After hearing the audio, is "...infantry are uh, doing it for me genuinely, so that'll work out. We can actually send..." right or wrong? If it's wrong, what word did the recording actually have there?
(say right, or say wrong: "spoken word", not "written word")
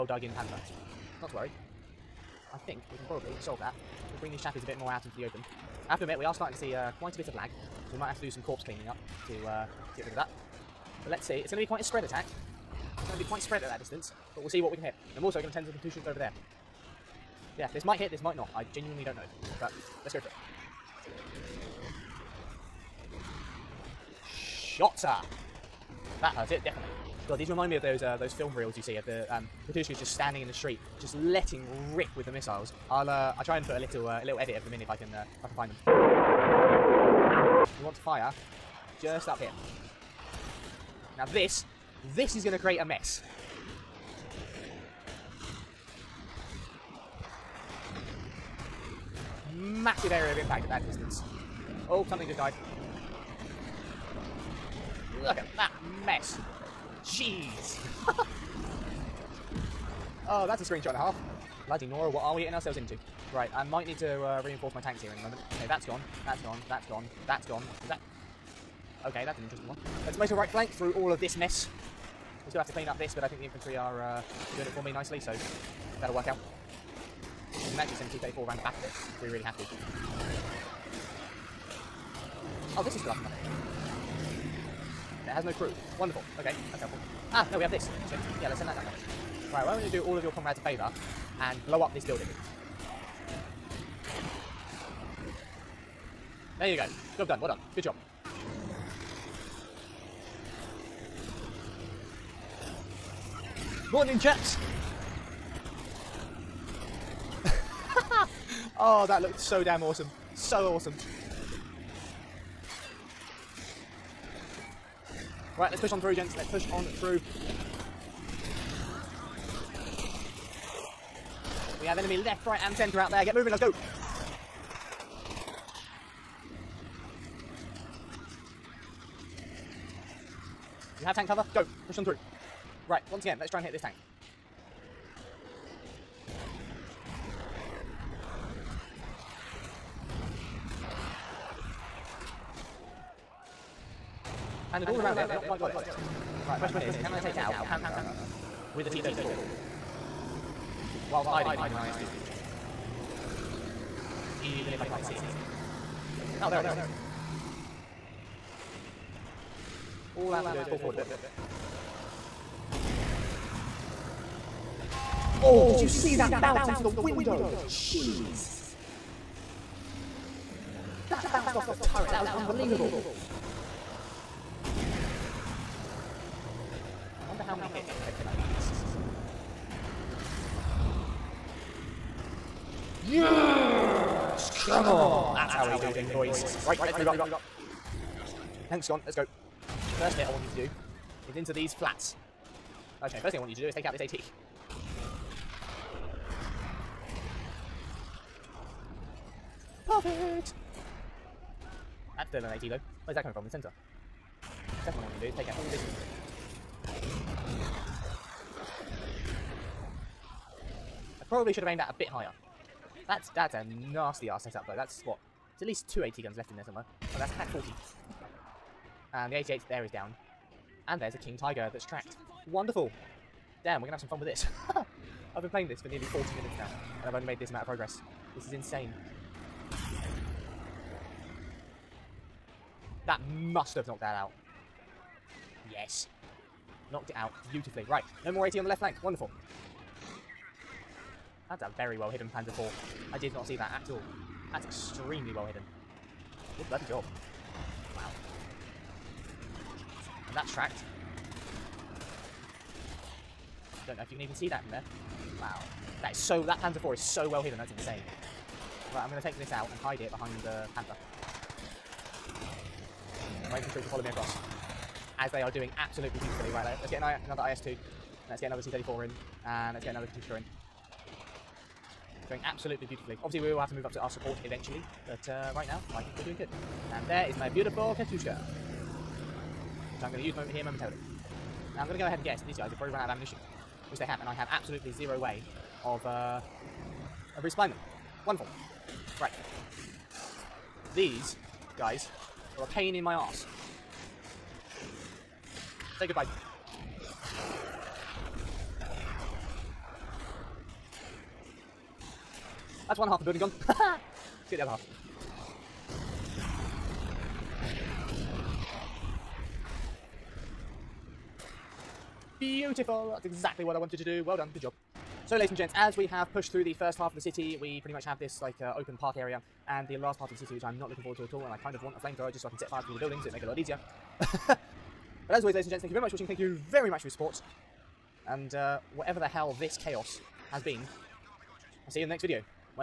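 wrong: "nicely", not "genuinely".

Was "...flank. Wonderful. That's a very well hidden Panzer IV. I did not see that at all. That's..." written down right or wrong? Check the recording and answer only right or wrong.
right.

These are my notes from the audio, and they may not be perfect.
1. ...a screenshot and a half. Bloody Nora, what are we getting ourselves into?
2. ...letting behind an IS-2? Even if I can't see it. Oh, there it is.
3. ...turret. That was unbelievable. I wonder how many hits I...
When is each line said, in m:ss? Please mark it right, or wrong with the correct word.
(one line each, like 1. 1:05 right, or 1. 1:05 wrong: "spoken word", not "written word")
1. 1:00 right
2. 2:31 wrong: "hiding", not "letting"
3. 2:51 right.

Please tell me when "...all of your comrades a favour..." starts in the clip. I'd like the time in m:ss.
1:30.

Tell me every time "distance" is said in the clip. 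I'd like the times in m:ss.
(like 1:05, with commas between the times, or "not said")
0:13, 0:50.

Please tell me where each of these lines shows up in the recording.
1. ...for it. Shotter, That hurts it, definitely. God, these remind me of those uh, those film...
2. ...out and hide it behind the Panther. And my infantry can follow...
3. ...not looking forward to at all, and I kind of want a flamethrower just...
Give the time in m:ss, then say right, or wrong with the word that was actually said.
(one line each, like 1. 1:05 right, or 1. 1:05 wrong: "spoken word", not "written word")
1. 0:20 right
2. 4:19 right
3. 5:20 right.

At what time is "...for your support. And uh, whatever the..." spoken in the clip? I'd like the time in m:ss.
5:27.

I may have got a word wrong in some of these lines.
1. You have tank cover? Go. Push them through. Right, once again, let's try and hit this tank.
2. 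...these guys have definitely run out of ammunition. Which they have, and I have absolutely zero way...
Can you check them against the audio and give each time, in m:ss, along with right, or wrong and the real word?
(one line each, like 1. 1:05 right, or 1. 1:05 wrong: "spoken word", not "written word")
1. 2:10 right
2. 4:42 wrong: "probably", not "definitely".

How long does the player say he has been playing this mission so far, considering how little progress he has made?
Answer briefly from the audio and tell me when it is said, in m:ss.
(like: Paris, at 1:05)
nearly 40 minutes, at 3:45.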